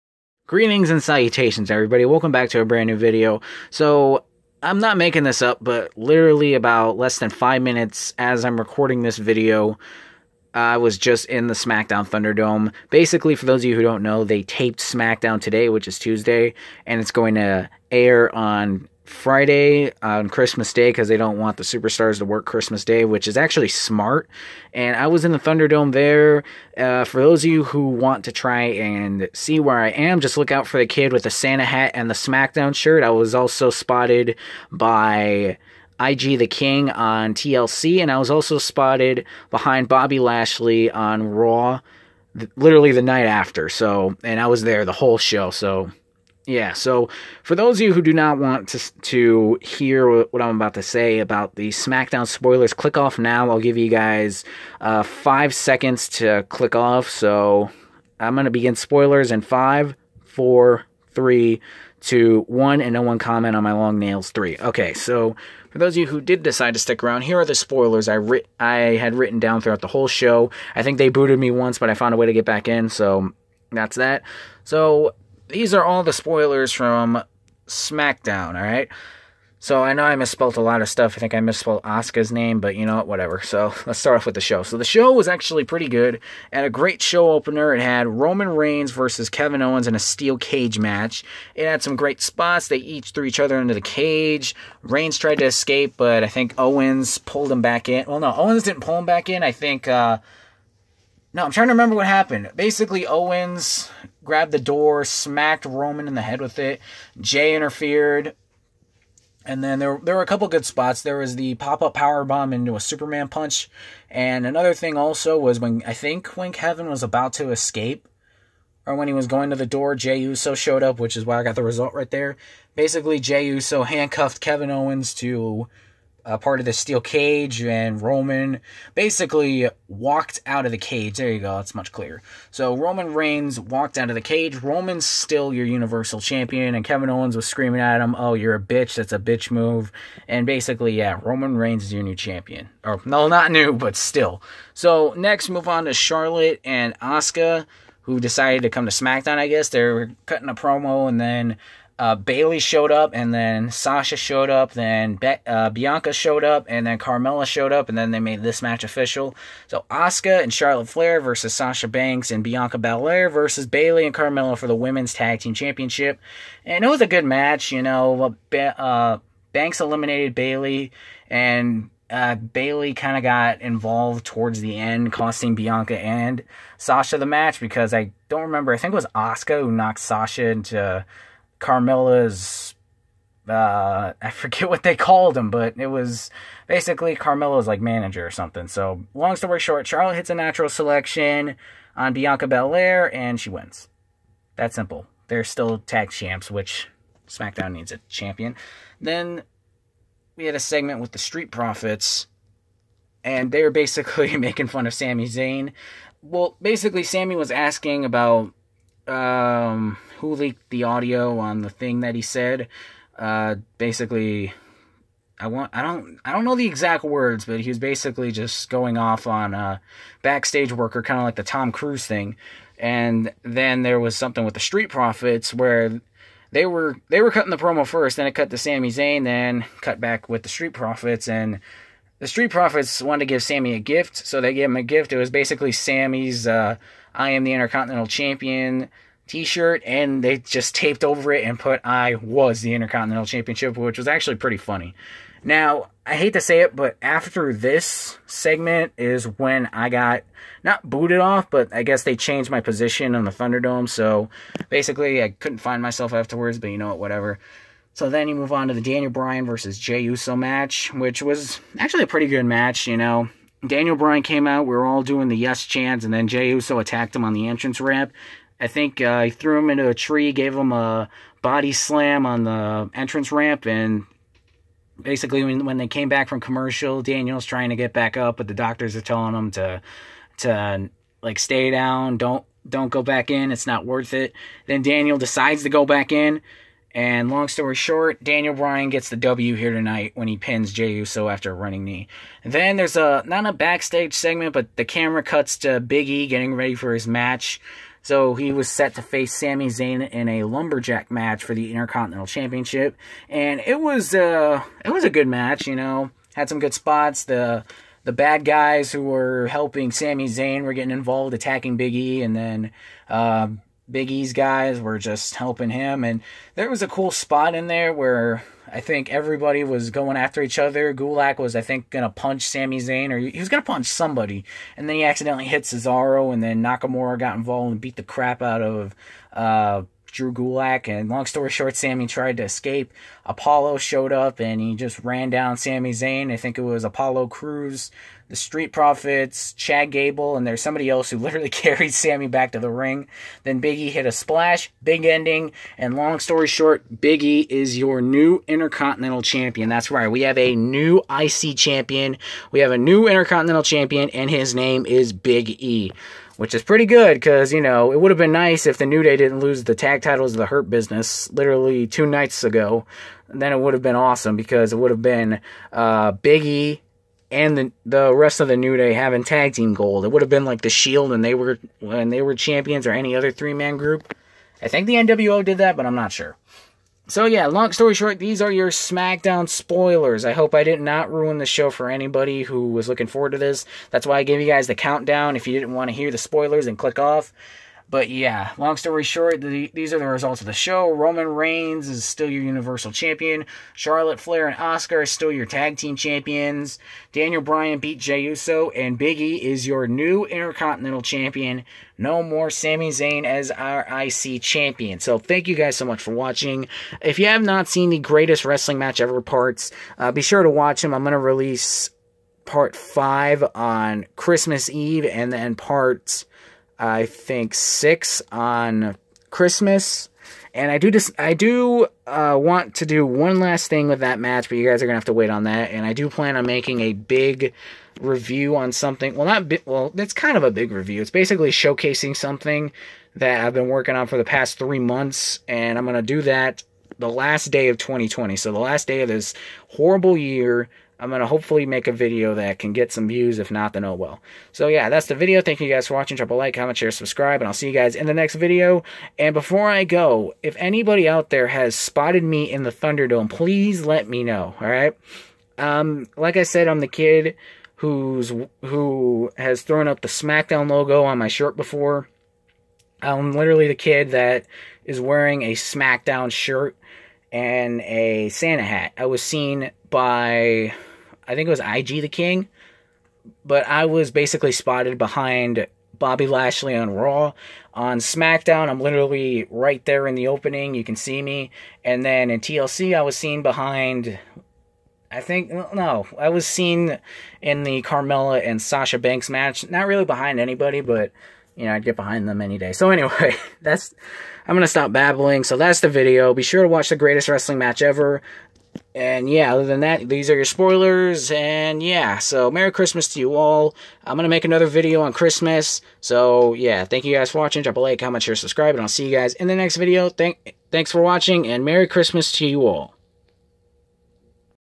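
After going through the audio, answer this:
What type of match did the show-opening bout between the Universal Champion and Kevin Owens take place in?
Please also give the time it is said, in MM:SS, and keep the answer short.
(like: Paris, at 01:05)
Steel cage match, at 01:29.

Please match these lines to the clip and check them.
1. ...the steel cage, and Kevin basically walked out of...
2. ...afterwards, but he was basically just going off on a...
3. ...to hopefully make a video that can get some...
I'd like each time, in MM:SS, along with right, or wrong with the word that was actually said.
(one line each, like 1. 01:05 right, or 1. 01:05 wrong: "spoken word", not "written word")
1. 02:06 wrong: "Roman", not "Kevin"
2. 03:37 wrong: "words", not "afterwards"
3. 07:21 right.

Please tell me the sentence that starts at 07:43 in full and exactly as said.
I'm literally the kid that is wearing a SmackDown shirt and a Santa hat.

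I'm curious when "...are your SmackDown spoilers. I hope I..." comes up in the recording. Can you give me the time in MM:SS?
06:18.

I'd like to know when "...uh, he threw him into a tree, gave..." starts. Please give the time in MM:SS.
04:29.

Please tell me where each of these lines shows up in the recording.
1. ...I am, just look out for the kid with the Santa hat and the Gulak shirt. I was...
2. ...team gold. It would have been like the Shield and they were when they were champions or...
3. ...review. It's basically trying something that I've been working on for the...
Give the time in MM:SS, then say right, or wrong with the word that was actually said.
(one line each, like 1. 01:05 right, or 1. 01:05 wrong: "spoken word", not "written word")
1. 00:29 wrong: "SmackDown", not "Gulak"
2. 06:09 right
3. 07:10 wrong: "showcasing", not "trying".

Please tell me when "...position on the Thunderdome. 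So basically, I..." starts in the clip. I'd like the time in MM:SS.
04:12.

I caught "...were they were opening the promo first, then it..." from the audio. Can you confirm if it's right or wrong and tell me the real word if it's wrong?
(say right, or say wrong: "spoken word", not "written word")
wrong: "cutting", not "opening".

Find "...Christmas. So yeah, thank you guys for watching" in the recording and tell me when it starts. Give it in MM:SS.
08:25.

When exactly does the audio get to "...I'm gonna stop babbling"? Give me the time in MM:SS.
08:14.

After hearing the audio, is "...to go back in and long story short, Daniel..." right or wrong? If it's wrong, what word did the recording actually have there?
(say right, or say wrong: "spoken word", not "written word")
right.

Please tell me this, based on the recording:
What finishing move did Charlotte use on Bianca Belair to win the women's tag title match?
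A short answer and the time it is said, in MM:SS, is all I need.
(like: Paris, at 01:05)
Natural selection, at 03:10.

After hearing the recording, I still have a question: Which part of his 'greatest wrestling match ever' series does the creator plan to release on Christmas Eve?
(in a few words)
Part 5.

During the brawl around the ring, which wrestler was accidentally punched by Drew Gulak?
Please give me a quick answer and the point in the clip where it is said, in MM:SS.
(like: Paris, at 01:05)
Cesaro, at 05:25.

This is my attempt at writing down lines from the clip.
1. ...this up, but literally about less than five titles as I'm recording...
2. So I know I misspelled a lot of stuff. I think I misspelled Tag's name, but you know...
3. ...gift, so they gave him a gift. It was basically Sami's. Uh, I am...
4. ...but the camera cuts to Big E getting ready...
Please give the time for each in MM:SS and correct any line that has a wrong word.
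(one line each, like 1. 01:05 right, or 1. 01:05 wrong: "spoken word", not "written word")
1. 00:05 wrong: "minutes", not "titles"
2. 01:19 wrong: "Asuka", not "Tag"
3. 03:53 right
4. 04:54 right.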